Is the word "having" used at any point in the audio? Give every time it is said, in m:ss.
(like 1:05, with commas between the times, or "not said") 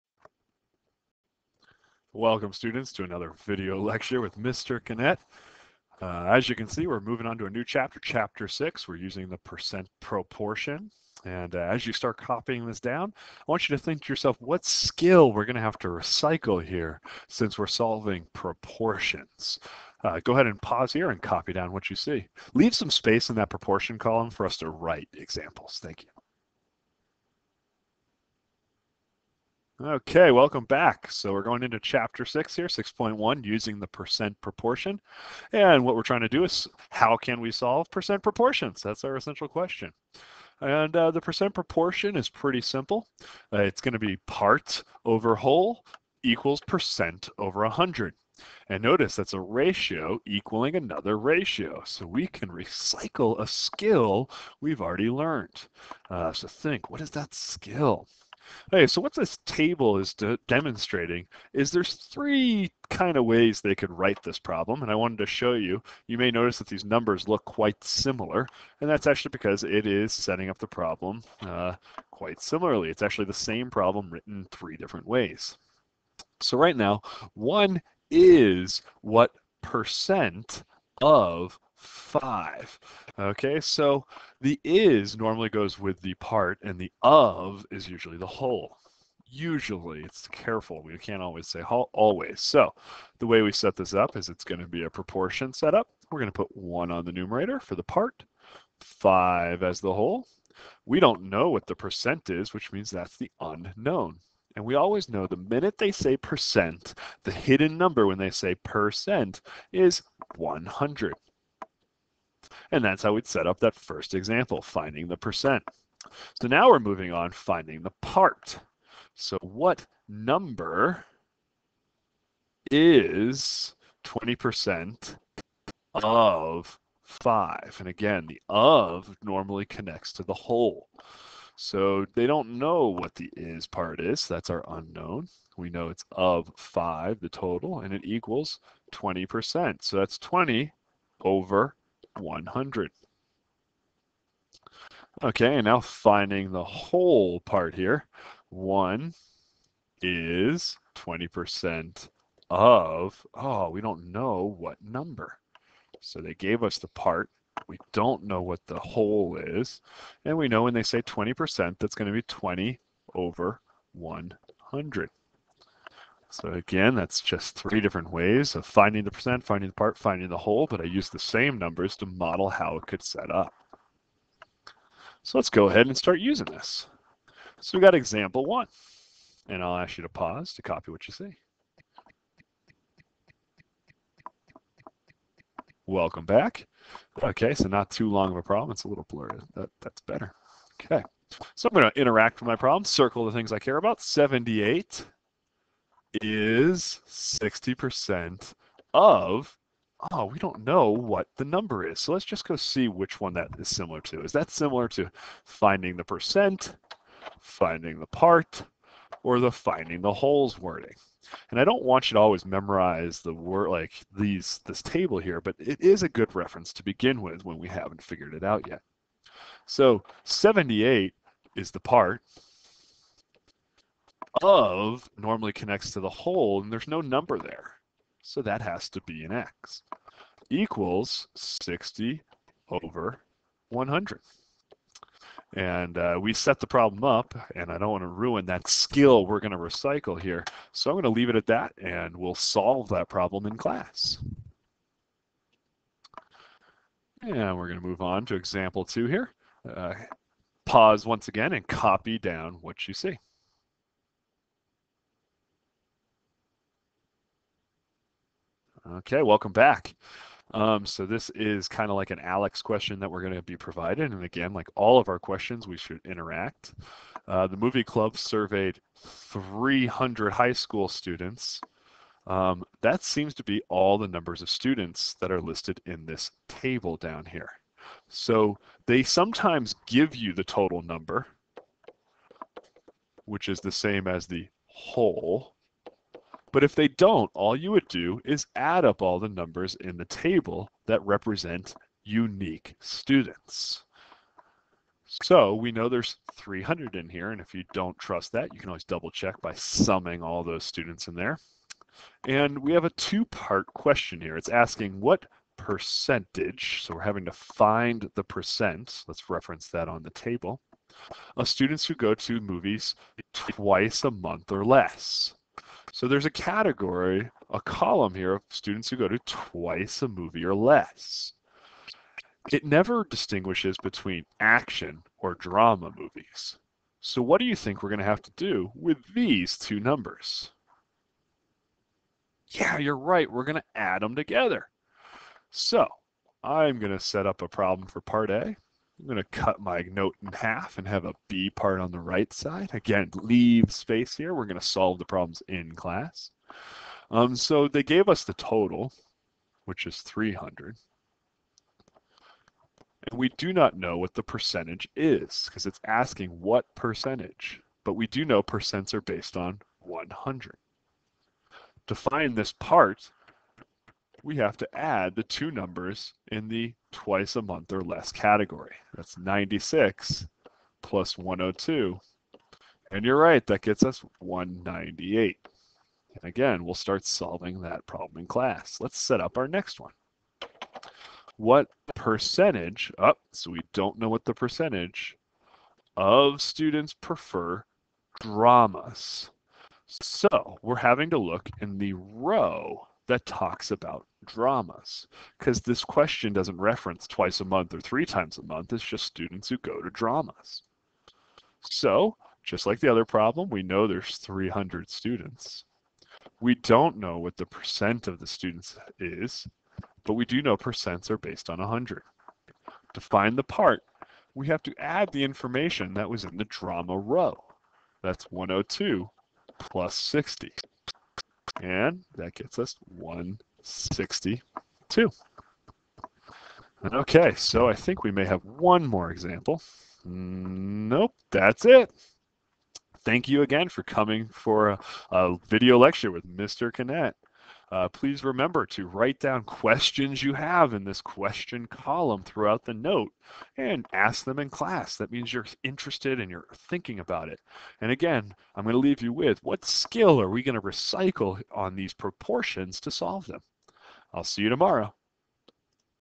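5:07, 6:30.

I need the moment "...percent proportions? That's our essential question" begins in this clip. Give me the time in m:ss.
0:37.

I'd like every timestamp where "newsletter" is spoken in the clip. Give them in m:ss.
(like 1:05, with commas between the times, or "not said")
not said.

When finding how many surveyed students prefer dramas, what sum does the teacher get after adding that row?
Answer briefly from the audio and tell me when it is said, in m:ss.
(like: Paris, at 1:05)
162, at 7:02.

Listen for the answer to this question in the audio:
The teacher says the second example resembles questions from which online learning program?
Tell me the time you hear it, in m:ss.
4:22.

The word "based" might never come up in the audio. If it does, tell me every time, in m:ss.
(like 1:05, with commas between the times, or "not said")
5:59, 6:51.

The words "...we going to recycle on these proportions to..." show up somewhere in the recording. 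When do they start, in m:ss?
7:30.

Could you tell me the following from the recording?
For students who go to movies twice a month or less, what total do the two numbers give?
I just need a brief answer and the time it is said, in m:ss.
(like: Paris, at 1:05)
198, at 6:14.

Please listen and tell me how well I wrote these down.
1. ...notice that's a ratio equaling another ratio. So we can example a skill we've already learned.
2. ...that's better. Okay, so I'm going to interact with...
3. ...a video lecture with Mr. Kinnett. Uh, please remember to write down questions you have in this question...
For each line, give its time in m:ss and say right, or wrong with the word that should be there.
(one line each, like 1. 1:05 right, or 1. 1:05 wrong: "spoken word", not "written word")
1. 0:48 wrong: "recycle", not "example"
2. 3:09 right
3. 7:15 right.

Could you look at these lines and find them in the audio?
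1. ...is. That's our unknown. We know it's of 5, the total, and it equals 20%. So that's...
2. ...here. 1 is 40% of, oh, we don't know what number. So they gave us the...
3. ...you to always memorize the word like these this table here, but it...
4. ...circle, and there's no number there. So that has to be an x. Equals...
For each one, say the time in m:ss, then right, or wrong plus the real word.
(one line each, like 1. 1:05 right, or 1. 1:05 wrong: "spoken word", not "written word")
1. 2:13 right
2. 2:27 wrong: "20", not "40"
3. 3:32 right
4. 3:46 wrong: "whole", not "circle".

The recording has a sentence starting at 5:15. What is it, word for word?
So there's a category, a column here of students who go to twice a movie or less.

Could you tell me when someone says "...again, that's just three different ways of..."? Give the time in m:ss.
2:46.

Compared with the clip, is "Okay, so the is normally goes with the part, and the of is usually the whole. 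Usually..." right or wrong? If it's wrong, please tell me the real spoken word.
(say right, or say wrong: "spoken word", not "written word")
right.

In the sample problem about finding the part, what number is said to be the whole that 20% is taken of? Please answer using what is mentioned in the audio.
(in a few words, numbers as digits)
5.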